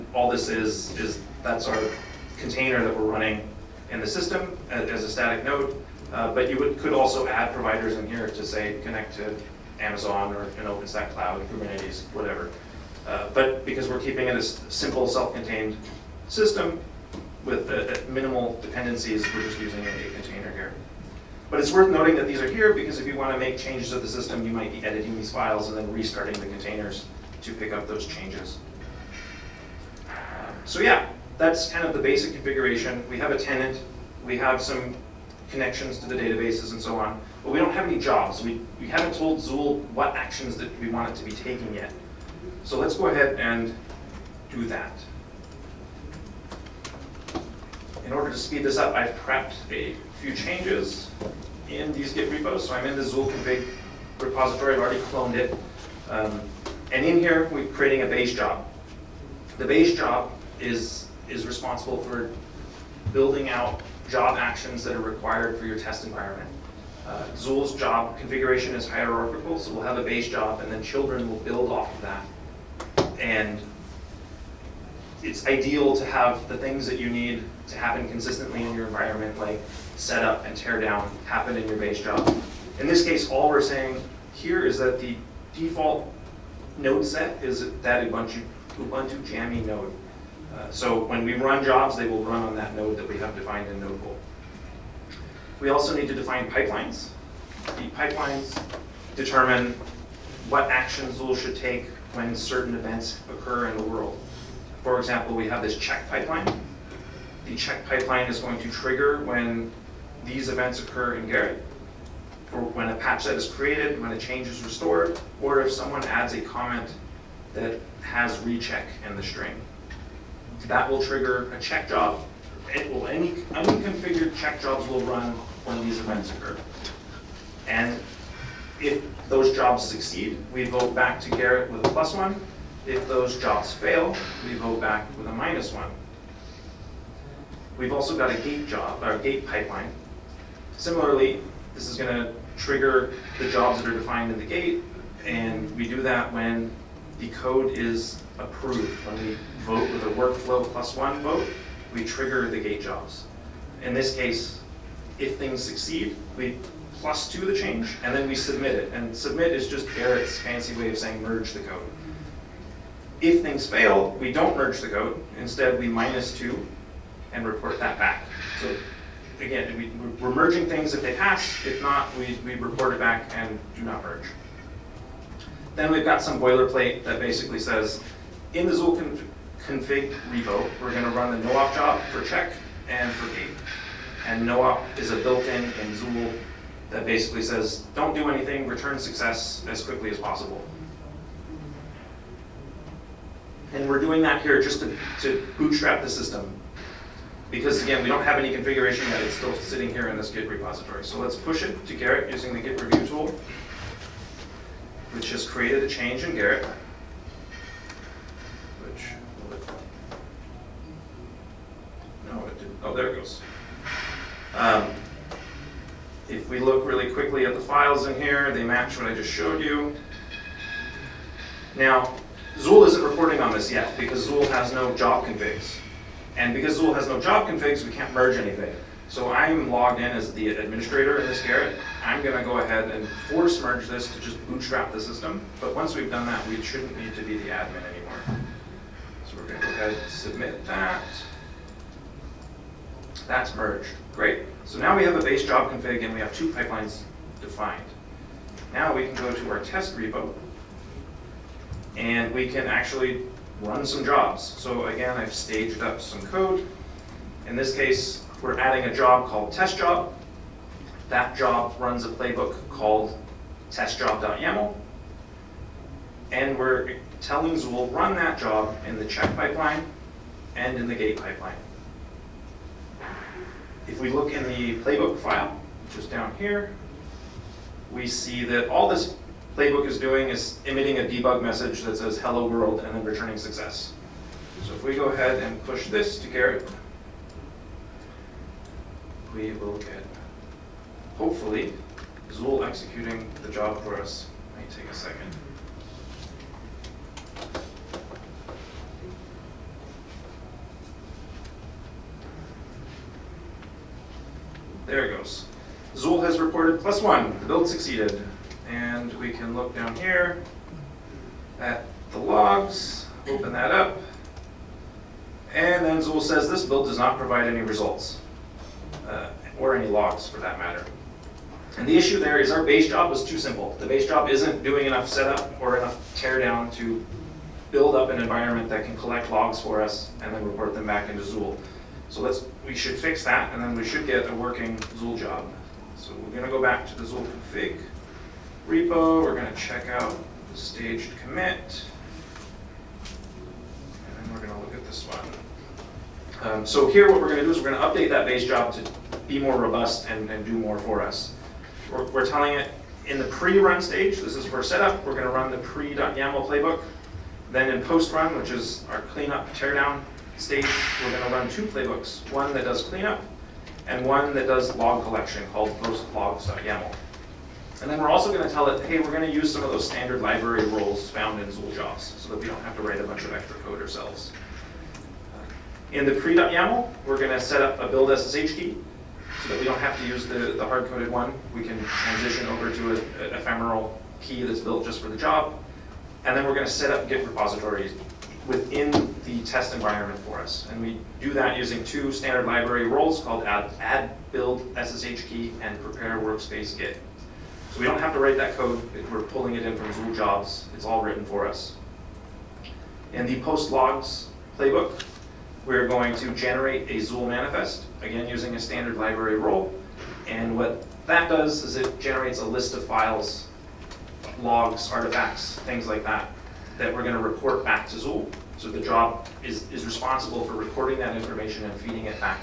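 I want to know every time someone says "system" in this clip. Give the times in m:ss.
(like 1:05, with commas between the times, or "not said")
0:04, 0:16, 0:24, 3:16, 3:54.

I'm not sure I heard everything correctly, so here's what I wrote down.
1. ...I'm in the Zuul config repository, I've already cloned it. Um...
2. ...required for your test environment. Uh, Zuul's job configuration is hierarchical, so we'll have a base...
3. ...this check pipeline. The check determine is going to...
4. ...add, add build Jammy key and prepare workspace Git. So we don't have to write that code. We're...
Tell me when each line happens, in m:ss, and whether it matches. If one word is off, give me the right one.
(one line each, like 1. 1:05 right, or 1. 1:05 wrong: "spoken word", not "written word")
1. 0:52 right
2. 1:05 right
3. 1:45 wrong: "pipeline", not "determine"
4. 6:33 wrong: "SSH", not "Jammy".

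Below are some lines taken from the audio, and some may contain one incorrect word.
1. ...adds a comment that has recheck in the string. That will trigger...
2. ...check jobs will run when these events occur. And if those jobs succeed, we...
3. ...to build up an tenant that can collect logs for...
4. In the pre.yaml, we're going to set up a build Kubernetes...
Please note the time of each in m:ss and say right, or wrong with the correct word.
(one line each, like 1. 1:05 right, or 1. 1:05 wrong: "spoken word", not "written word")
1. 1:56 right
2. 2:04 right
3. 5:26 wrong: "environment", not "tenant"
4. 6:15 wrong: "SSH", not "Kubernetes".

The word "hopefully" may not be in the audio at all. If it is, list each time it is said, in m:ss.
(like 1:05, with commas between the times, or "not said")
4:51.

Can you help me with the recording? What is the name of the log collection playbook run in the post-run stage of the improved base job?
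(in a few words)
postlogs.yml.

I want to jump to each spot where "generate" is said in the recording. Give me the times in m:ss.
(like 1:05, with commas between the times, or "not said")
6:46, 6:51.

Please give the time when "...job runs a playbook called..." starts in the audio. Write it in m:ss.
4:21.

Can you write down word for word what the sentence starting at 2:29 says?
When we vote with a workflow plus one vote, we trigger the gate jobs.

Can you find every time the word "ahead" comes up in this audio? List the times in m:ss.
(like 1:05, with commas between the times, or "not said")
0:43, 3:52, 3:59, 4:45.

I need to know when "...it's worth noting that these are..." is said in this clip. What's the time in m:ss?
0:21.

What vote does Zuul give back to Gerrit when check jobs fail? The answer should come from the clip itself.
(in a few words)
minus one.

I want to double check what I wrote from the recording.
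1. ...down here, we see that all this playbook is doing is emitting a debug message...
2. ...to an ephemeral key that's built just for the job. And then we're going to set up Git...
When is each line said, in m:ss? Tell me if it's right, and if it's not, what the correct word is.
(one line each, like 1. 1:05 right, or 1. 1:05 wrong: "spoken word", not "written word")
1. 4:36 right
2. 6:22 right.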